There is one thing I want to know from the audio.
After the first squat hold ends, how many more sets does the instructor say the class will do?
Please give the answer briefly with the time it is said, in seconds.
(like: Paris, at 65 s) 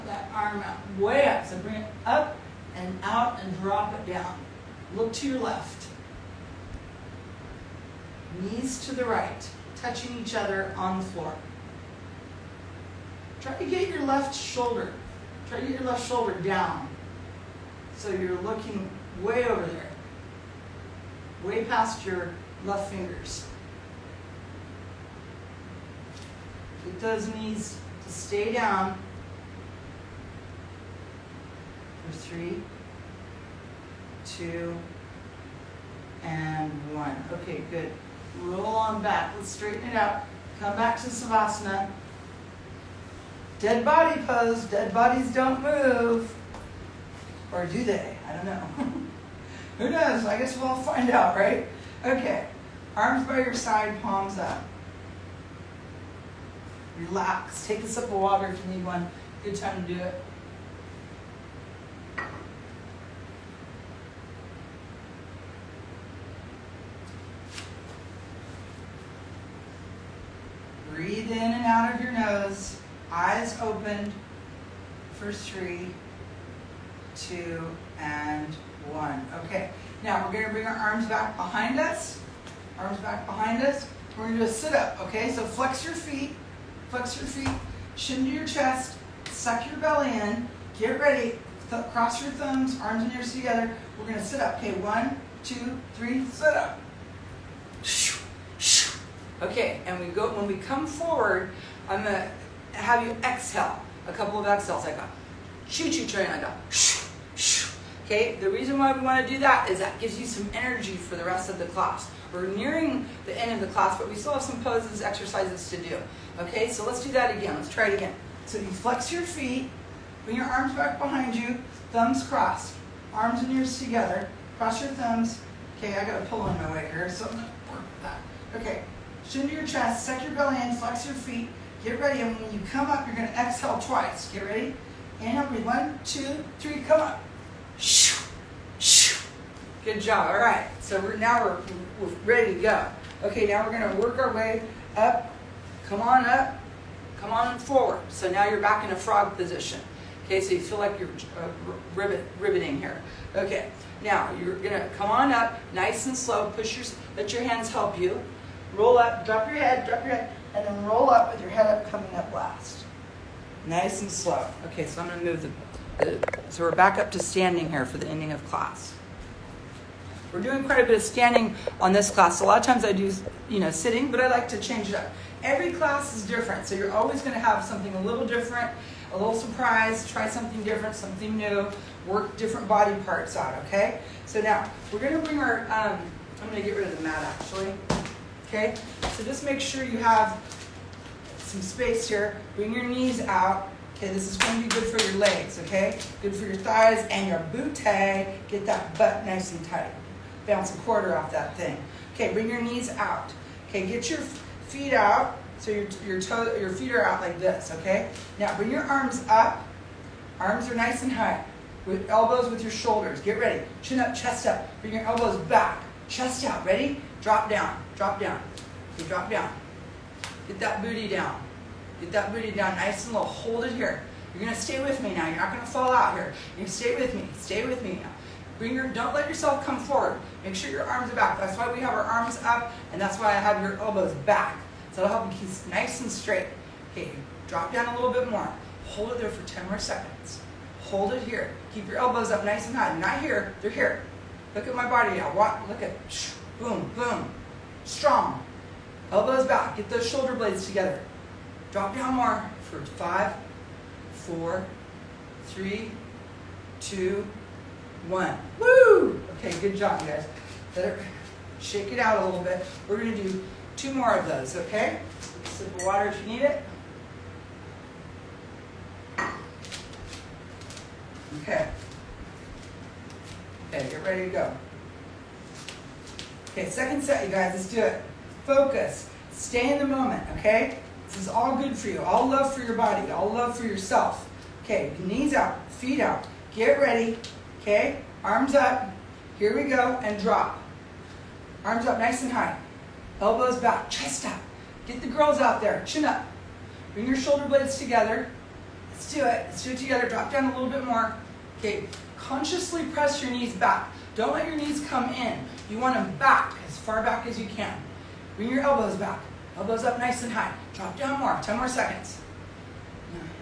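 2, at 263 s.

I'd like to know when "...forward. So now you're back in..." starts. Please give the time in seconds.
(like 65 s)
147 s.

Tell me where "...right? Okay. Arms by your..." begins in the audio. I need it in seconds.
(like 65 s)
51 s.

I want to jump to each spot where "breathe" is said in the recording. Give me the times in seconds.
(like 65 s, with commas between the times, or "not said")
70 s, 135 s.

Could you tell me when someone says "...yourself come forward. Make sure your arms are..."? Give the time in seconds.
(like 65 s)
229 s.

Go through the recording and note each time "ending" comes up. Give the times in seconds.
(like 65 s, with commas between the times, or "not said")
168 s.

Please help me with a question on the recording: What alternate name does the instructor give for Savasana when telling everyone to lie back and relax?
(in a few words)
Dead body pose.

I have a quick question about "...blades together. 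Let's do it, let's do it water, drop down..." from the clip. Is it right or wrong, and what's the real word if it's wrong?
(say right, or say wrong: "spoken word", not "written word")
wrong: "together", not "water".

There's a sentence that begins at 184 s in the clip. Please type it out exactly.
So now, we're going to bring our, um, I'm going to get rid of the mat, actually okay?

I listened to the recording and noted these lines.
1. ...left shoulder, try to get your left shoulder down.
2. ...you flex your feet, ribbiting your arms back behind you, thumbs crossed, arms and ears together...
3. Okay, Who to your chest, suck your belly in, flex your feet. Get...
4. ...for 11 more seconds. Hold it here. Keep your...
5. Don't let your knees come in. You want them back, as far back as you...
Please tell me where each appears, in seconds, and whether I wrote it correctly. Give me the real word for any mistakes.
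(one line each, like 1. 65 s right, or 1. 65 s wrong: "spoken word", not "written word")
1. 14 s right
2. 118 s wrong: "bring", not "ribbiting"
3. 128 s wrong: "Chin", not "Who"
4. 239 s wrong: "10", not "11"
5. 304 s right.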